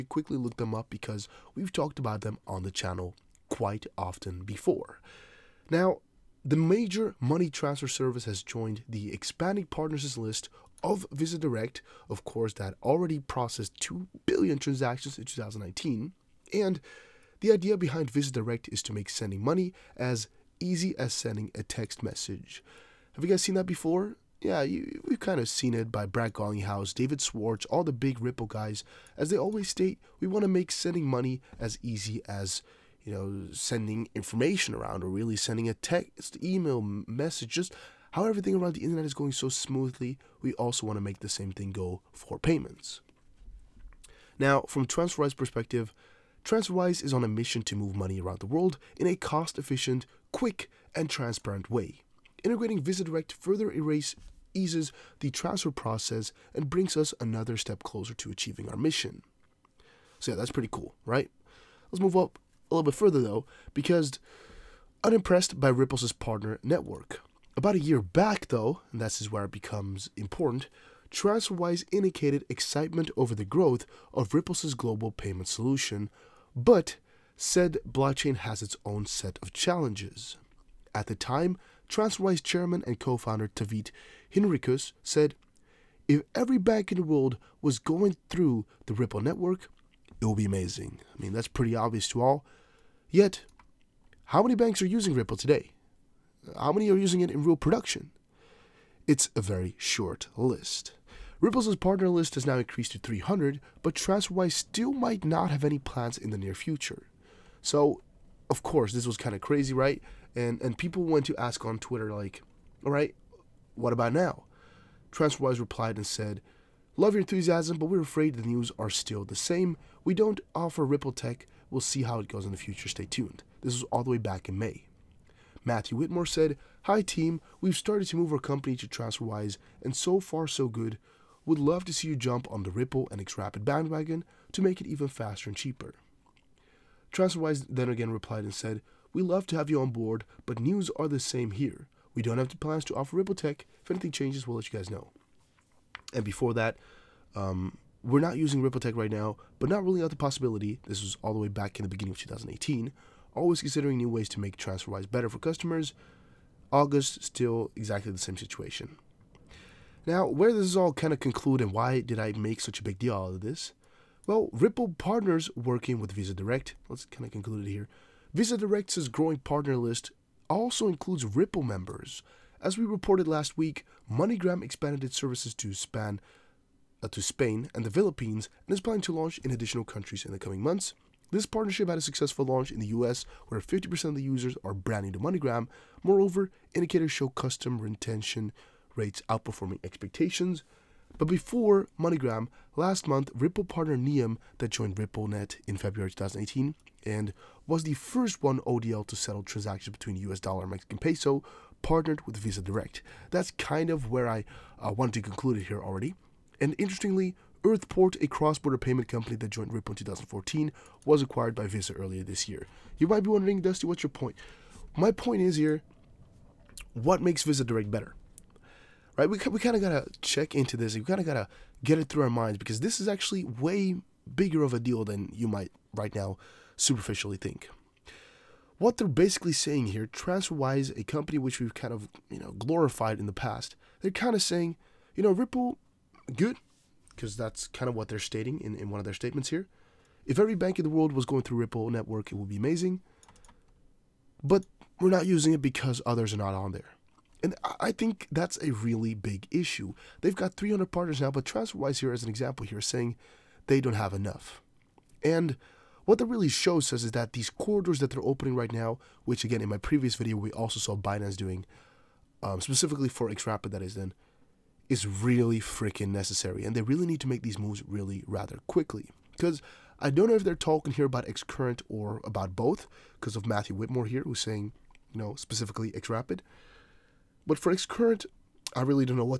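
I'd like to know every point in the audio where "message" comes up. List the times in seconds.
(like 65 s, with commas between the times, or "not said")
22 s, 36 s.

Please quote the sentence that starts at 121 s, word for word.
We'll see how it goes in the future.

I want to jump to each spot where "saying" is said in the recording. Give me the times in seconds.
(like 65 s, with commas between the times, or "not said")
229 s, 234 s, 252 s, 274 s.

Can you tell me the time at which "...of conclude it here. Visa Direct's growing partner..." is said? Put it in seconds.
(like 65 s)
167 s.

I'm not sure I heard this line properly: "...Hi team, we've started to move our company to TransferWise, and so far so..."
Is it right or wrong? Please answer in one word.
right.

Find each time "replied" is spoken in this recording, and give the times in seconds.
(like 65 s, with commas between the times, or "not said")
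115 s, 138 s.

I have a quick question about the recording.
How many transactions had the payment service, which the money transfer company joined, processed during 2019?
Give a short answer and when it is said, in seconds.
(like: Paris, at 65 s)
2 billion, at 13 s.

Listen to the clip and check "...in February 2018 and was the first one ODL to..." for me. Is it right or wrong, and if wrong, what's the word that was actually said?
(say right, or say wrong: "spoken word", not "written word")
right.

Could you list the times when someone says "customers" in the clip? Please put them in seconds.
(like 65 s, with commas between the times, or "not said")
155 s, 187 s.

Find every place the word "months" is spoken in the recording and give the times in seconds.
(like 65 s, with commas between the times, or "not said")
180 s, 193 s.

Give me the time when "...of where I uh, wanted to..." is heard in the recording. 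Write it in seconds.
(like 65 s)
203 s.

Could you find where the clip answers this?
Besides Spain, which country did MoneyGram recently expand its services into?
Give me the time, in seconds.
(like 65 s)
177 s.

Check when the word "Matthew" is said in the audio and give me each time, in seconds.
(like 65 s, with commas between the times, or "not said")
125 s, 273 s.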